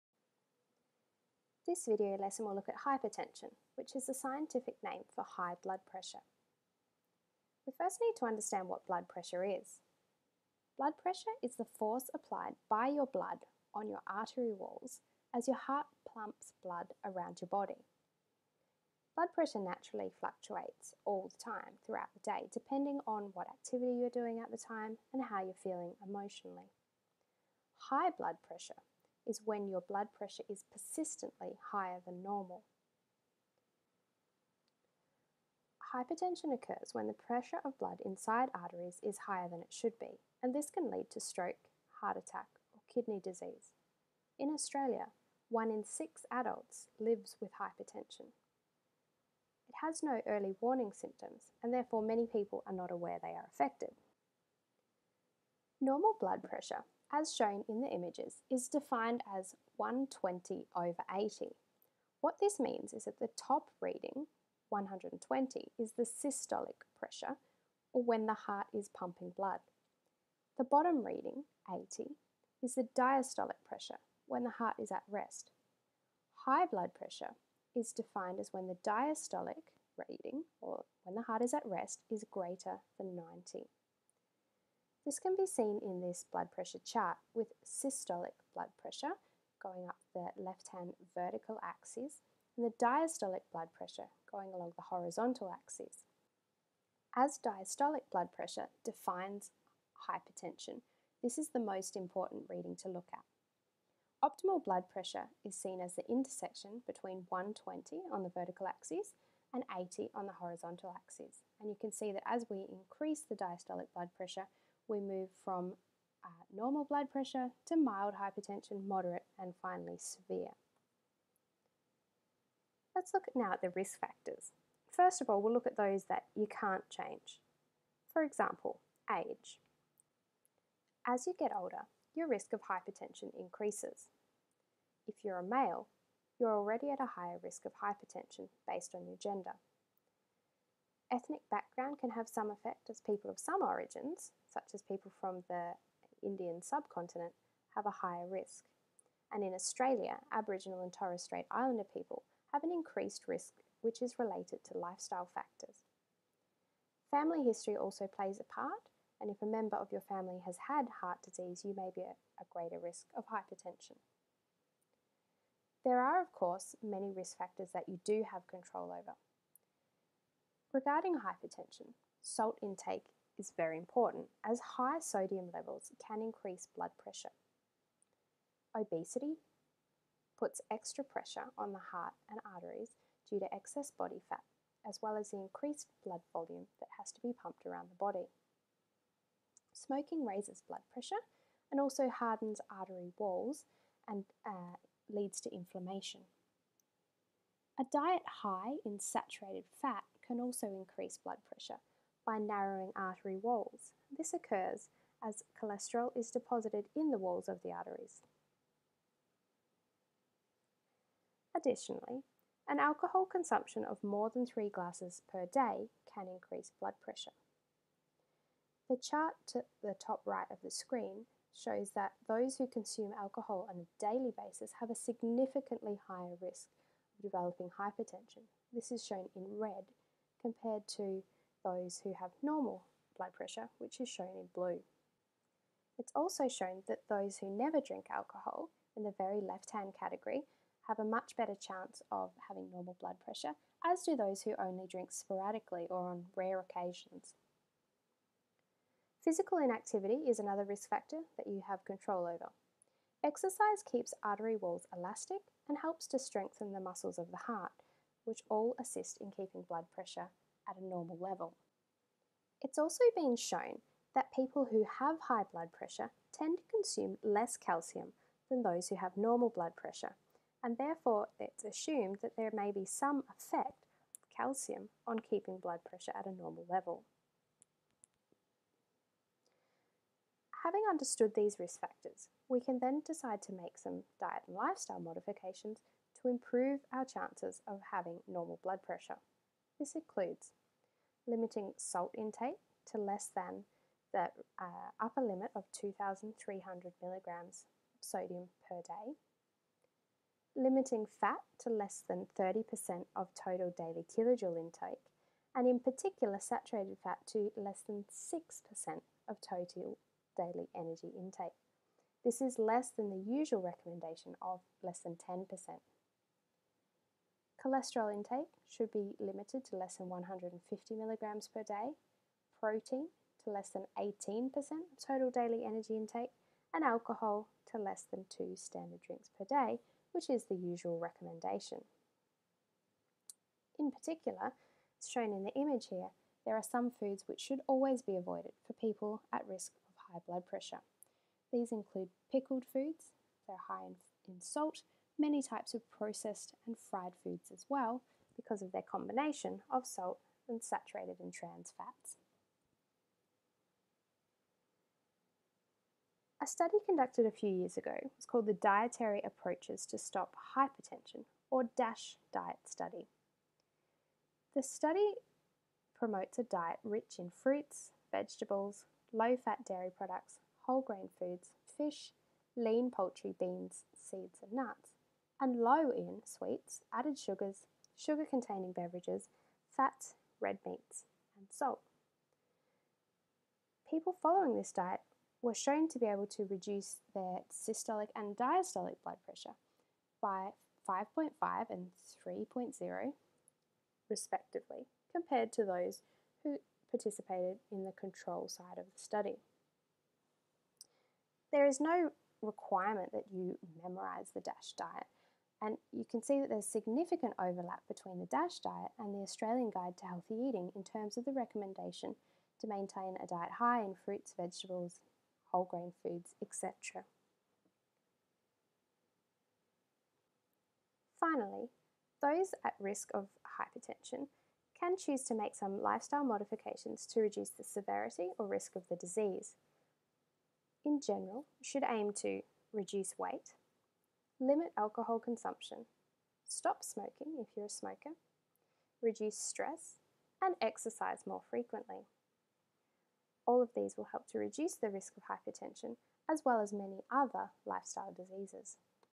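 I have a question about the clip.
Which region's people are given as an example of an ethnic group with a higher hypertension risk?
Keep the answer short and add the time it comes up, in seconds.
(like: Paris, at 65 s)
Indian subcontinent, at 146 s.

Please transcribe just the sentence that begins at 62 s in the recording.
What this means is that the top reading, 120, is the systolic pressure, or when the heart is pumping blood.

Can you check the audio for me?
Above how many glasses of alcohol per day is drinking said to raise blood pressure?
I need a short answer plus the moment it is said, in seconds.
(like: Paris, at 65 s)
3, at 214 s.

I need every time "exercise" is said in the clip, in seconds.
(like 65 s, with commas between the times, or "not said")
253 s, 440 s.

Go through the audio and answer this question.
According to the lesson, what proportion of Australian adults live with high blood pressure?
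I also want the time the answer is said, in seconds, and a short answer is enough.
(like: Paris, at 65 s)
1 in 6, at 45 s.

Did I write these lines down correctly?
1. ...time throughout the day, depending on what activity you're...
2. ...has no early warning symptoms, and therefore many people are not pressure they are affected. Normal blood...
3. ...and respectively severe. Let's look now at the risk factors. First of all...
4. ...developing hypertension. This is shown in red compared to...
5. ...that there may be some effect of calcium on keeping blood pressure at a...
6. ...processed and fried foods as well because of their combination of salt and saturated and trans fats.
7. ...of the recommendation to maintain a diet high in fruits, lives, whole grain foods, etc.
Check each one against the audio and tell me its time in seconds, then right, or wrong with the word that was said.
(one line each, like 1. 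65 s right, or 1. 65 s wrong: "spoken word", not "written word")
1. 21 s right
2. 49 s wrong: "aware", not "pressure"
3. 119 s wrong: "finally", not "respectively"
4. 227 s right
5. 272 s right
6. 345 s right
7. 411 s wrong: "vegetables", not "lives".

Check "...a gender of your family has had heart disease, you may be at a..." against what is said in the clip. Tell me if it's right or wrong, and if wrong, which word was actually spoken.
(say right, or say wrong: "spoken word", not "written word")
wrong: "member", not "gender".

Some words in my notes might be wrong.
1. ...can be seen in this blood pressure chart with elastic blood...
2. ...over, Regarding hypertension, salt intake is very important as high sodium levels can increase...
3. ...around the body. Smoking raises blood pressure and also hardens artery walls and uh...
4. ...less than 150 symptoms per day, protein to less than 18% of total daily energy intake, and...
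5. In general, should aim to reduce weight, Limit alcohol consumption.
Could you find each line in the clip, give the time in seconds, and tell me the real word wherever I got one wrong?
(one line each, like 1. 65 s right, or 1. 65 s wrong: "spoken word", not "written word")
1. 85 s wrong: "systolic", not "elastic"
2. 168 s right
3. 187 s right
4. 319 s wrong: "milligrams", not "symptoms"
5. 430 s right.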